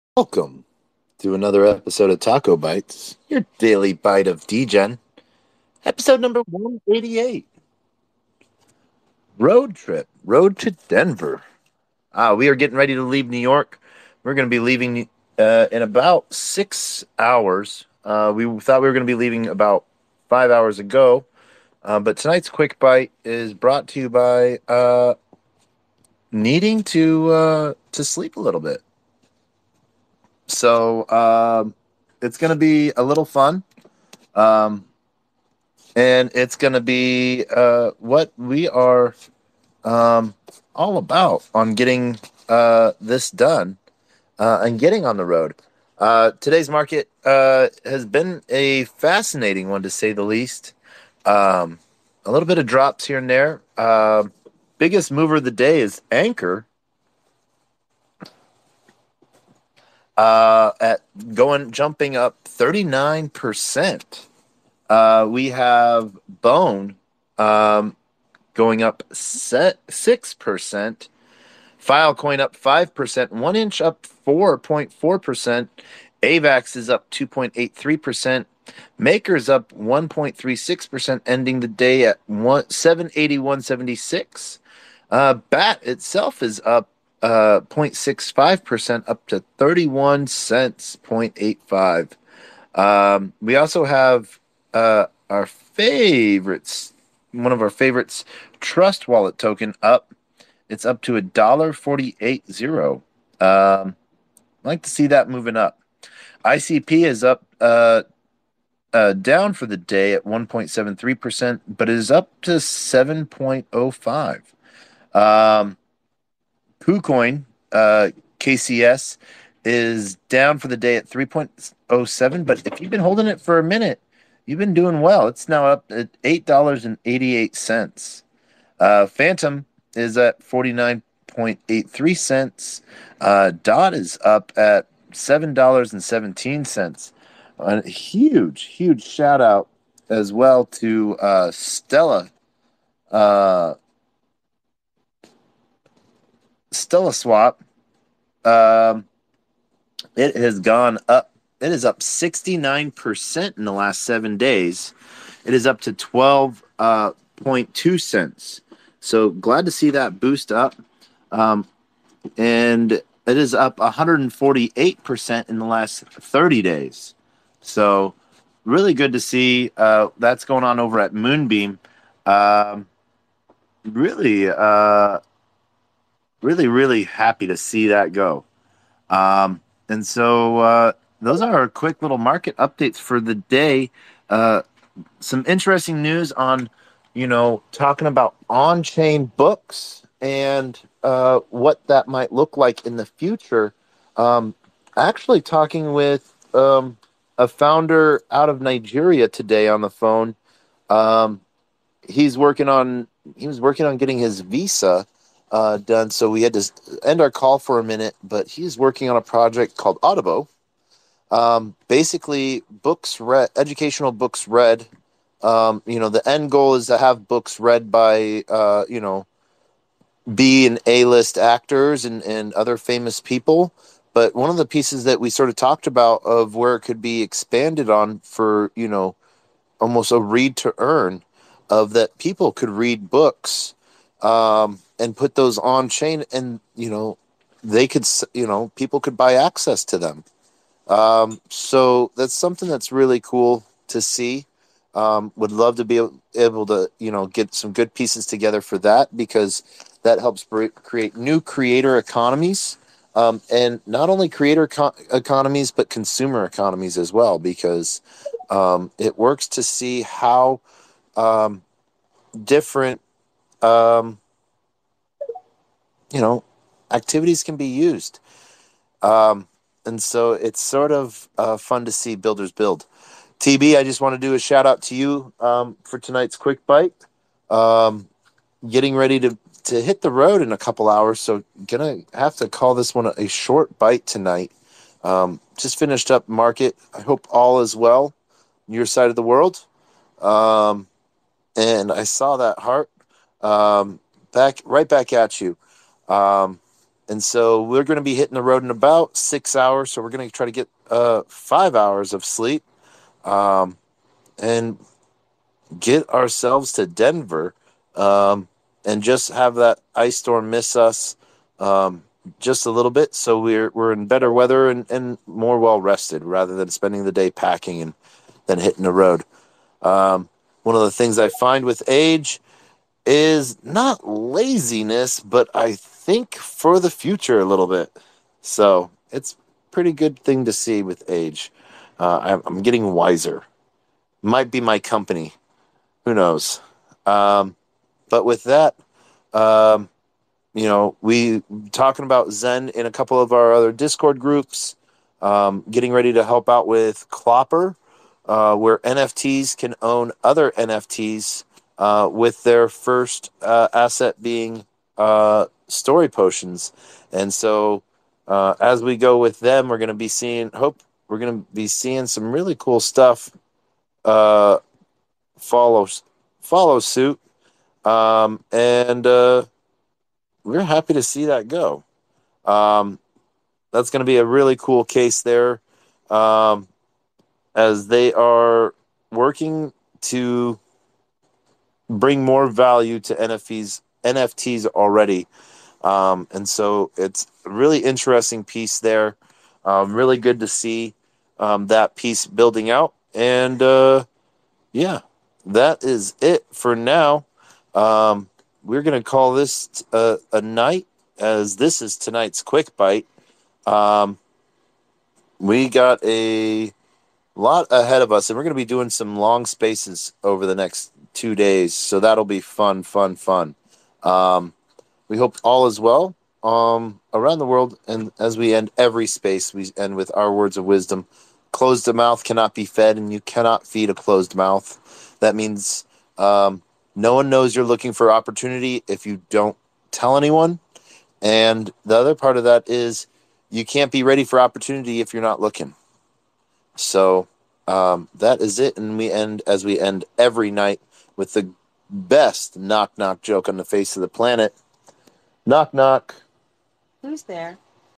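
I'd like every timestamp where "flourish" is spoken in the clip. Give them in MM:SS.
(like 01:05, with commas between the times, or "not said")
not said.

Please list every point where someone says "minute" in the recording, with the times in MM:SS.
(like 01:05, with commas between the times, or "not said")
02:03, 03:27.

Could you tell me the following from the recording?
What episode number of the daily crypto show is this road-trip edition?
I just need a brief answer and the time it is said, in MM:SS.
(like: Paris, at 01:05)
188, at 00:06.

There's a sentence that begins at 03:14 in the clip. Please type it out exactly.
Um, actually, talking with um, a founder out of Nigeria today on the phone.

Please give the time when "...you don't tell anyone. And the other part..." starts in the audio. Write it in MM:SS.
07:09.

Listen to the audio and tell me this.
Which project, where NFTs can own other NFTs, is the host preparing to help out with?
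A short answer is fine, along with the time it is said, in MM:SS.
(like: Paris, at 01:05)
Clopper, at 05:47.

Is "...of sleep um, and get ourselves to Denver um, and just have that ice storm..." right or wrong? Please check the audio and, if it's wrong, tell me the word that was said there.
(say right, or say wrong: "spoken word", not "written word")
right.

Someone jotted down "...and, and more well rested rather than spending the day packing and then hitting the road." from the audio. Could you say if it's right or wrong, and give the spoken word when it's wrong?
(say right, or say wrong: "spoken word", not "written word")
right.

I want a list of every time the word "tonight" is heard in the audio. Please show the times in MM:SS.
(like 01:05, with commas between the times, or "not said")
00:22, 04:35, 04:44, 06:41.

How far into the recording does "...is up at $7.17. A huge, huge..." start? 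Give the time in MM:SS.
02:13.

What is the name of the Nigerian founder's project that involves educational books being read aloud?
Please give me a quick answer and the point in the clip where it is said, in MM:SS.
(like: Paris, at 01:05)
Audible, at 03:30.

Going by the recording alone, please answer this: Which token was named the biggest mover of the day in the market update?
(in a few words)
Anchor.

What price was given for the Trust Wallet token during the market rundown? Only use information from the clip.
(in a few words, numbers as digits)
$1.48.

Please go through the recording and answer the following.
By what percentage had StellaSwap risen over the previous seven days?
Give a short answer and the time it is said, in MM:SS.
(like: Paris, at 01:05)
69%, at 02:31.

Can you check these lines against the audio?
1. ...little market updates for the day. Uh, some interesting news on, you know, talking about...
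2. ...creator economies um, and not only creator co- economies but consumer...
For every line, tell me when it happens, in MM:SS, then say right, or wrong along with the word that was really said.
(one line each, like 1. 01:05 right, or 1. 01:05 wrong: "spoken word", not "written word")
1. 03:02 right
2. 04:11 right.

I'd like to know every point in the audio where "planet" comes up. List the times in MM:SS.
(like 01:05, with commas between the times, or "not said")
07:24.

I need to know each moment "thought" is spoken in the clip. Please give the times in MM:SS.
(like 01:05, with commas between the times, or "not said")
00:18.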